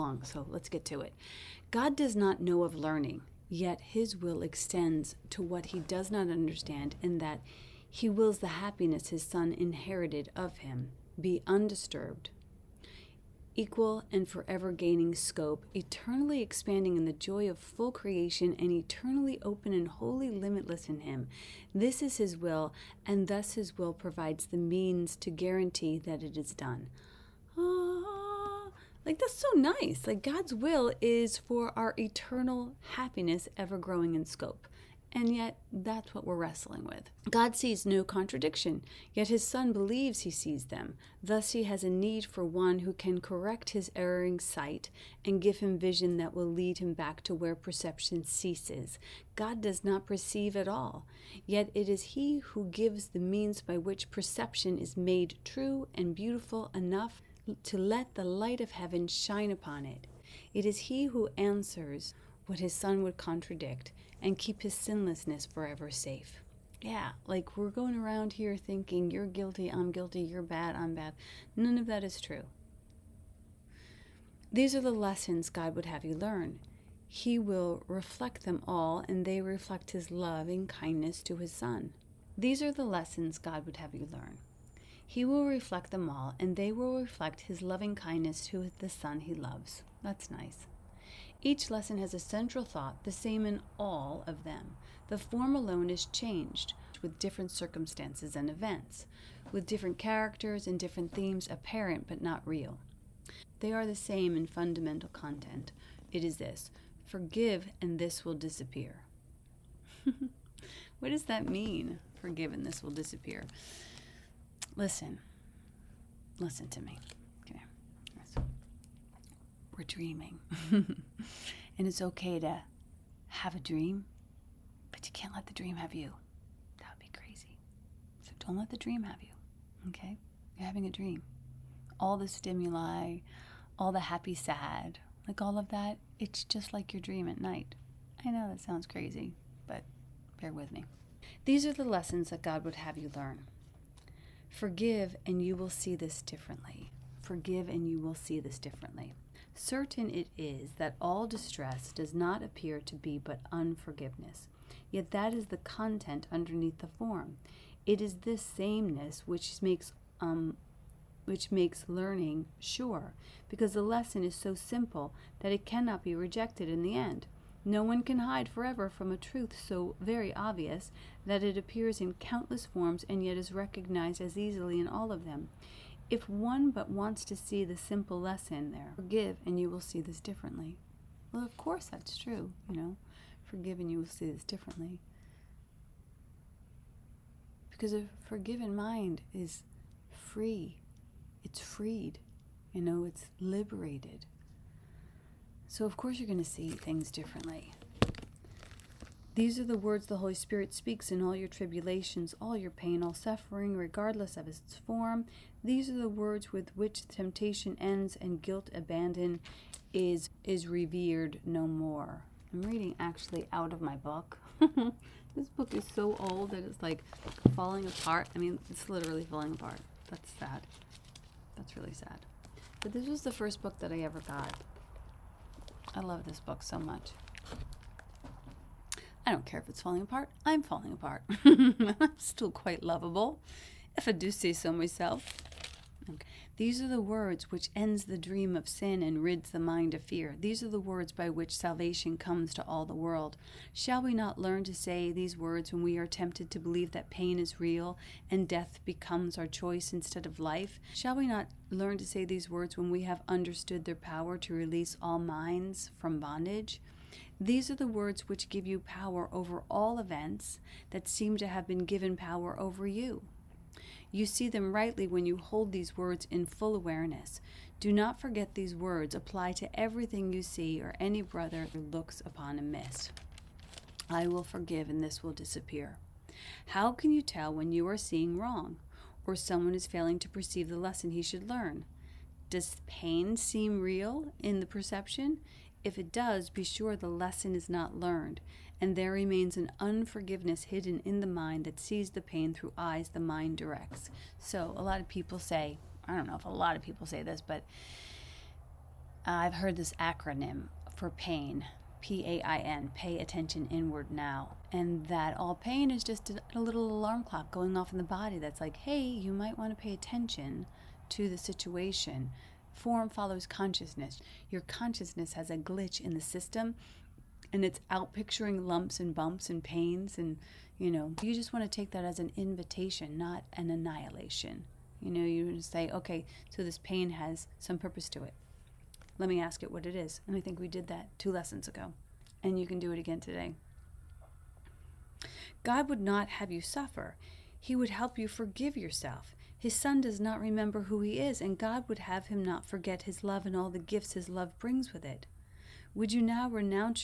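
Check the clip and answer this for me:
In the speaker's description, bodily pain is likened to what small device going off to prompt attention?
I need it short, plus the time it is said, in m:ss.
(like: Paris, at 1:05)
Little alarm clock, at 5:06.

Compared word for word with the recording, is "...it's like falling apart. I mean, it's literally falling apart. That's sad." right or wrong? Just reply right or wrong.
right.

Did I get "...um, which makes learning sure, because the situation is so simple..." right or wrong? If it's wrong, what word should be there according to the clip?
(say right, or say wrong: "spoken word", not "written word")
wrong: "lesson", not "situation".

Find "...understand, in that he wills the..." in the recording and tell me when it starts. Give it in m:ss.
0:06.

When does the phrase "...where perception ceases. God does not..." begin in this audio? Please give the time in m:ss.
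0:47.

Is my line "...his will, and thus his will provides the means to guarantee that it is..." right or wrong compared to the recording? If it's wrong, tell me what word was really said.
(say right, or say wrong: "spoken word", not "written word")
right.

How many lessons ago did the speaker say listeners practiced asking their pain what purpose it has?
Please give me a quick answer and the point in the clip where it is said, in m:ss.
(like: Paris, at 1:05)
2, at 5:31.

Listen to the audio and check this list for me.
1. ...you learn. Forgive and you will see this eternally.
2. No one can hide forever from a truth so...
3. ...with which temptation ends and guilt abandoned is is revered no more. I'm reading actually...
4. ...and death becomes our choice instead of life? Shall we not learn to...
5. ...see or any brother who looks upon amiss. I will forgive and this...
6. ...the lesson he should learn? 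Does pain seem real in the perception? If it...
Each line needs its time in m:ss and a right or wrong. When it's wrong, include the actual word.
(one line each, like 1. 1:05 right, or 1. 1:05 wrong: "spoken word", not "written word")
1. 2:22 wrong: "differently", not "eternally"
2. 2:47 right
3. 3:26 right
4. 4:08 right
5. 4:30 right
6. 4:40 right.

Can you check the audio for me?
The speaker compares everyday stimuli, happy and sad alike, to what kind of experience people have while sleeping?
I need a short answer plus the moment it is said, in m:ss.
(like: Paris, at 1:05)
Your dream at night, at 2:16.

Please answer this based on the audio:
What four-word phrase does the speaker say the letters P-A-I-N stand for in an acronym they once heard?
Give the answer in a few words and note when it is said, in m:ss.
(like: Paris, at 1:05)
Pay attention inward now, at 5:02.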